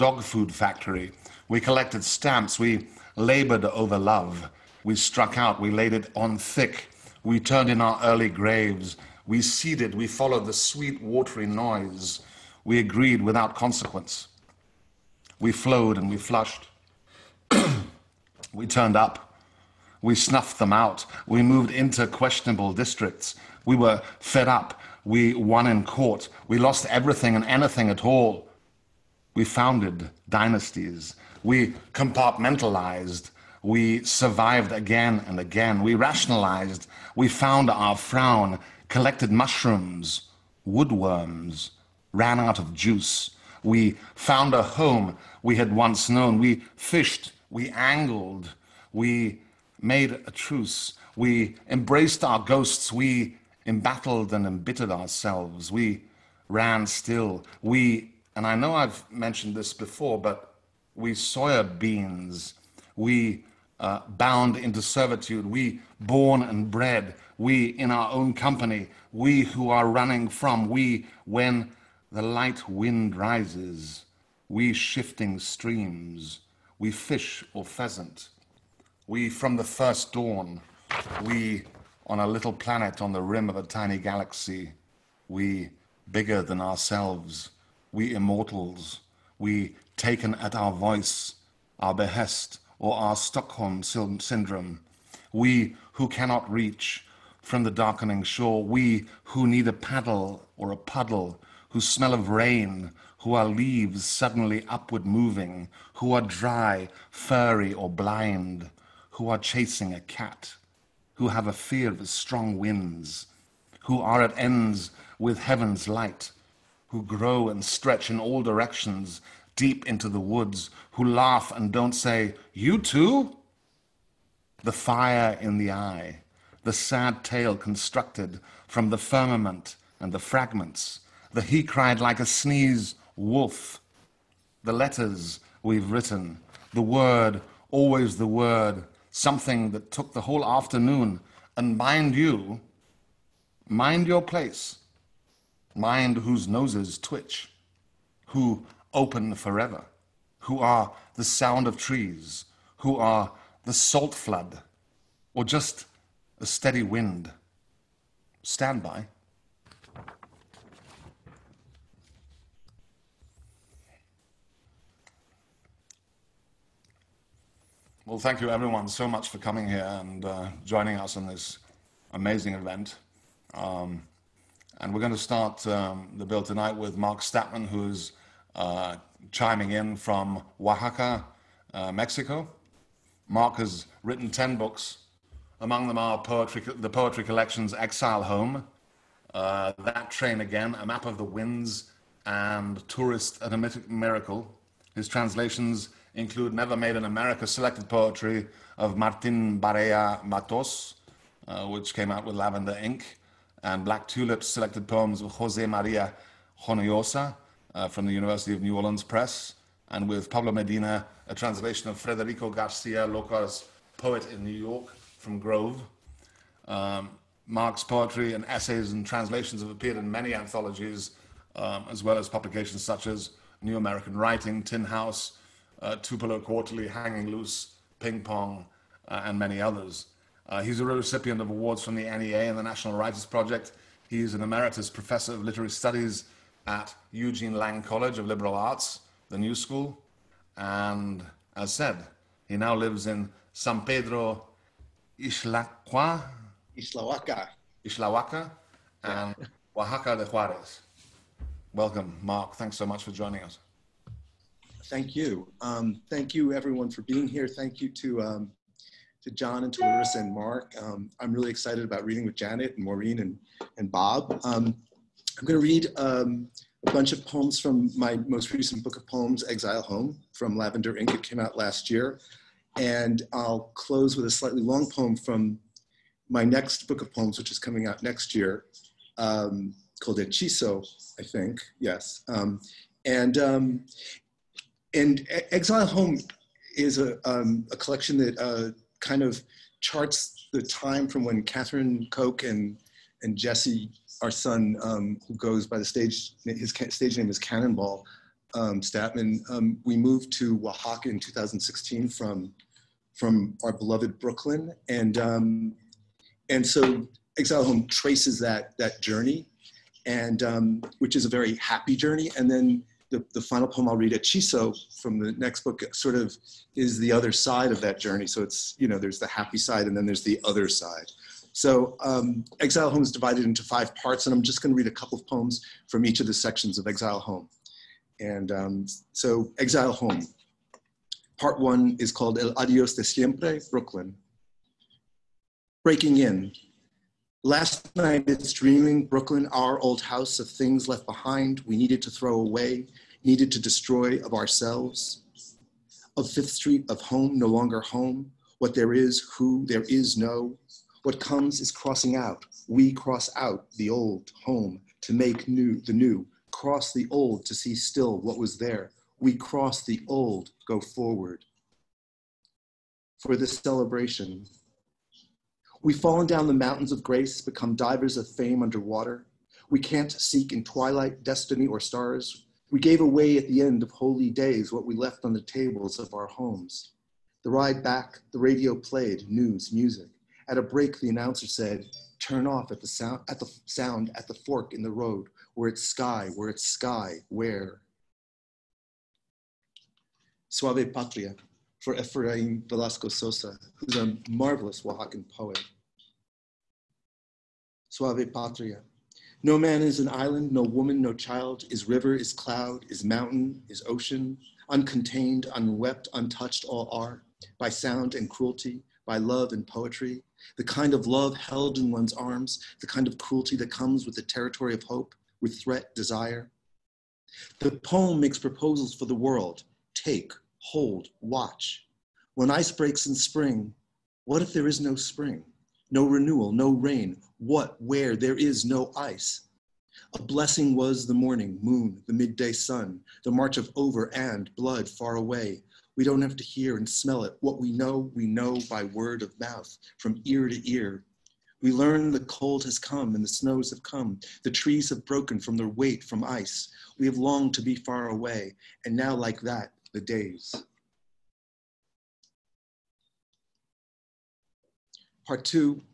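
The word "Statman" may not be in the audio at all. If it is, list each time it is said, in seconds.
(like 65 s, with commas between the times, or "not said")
177 s, 298 s.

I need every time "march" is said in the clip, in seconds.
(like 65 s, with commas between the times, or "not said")
433 s.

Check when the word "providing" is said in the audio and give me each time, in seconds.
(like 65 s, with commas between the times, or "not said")
not said.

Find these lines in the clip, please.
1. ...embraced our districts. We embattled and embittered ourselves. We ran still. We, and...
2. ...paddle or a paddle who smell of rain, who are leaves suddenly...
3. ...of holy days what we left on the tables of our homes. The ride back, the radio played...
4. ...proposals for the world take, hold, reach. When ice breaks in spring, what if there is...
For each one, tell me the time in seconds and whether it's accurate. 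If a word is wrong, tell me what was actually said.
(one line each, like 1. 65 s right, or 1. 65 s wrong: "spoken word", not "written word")
1. 51 s wrong: "ghosts", not "districts"
2. 99 s wrong: "puddle", not "paddle"
3. 373 s right
4. 418 s wrong: "watch", not "reach".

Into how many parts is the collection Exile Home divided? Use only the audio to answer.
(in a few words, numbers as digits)
five.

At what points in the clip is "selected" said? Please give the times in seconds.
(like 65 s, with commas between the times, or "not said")
197 s, 204 s.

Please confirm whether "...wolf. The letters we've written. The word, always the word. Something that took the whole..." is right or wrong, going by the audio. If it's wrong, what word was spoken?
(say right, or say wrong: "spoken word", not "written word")
right.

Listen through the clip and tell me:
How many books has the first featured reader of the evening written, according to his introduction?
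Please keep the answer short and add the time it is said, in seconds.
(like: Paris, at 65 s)
10, at 184 s.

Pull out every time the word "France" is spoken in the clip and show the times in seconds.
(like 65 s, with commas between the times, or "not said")
not said.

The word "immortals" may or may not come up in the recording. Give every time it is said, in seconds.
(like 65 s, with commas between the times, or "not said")
88 s.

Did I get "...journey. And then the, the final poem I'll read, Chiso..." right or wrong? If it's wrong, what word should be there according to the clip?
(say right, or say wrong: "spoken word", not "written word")
right.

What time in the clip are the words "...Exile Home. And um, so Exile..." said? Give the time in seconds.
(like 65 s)
326 s.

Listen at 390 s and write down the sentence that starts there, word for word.
Suave Patria for Efrain Velasco Sosa, who's a marvelous Oaxacan poet.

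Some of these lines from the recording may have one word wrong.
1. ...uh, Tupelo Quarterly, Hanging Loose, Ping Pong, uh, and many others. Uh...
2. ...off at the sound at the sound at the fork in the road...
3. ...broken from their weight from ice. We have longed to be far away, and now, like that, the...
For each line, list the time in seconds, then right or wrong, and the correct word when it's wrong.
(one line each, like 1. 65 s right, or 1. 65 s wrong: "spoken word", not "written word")
1. 225 s right
2. 382 s right
3. 445 s right.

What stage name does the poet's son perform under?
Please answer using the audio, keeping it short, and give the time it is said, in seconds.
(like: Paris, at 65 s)
Cannonball, at 297 s.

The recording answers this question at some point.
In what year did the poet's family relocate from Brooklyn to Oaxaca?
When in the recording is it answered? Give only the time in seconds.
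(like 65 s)
301 s.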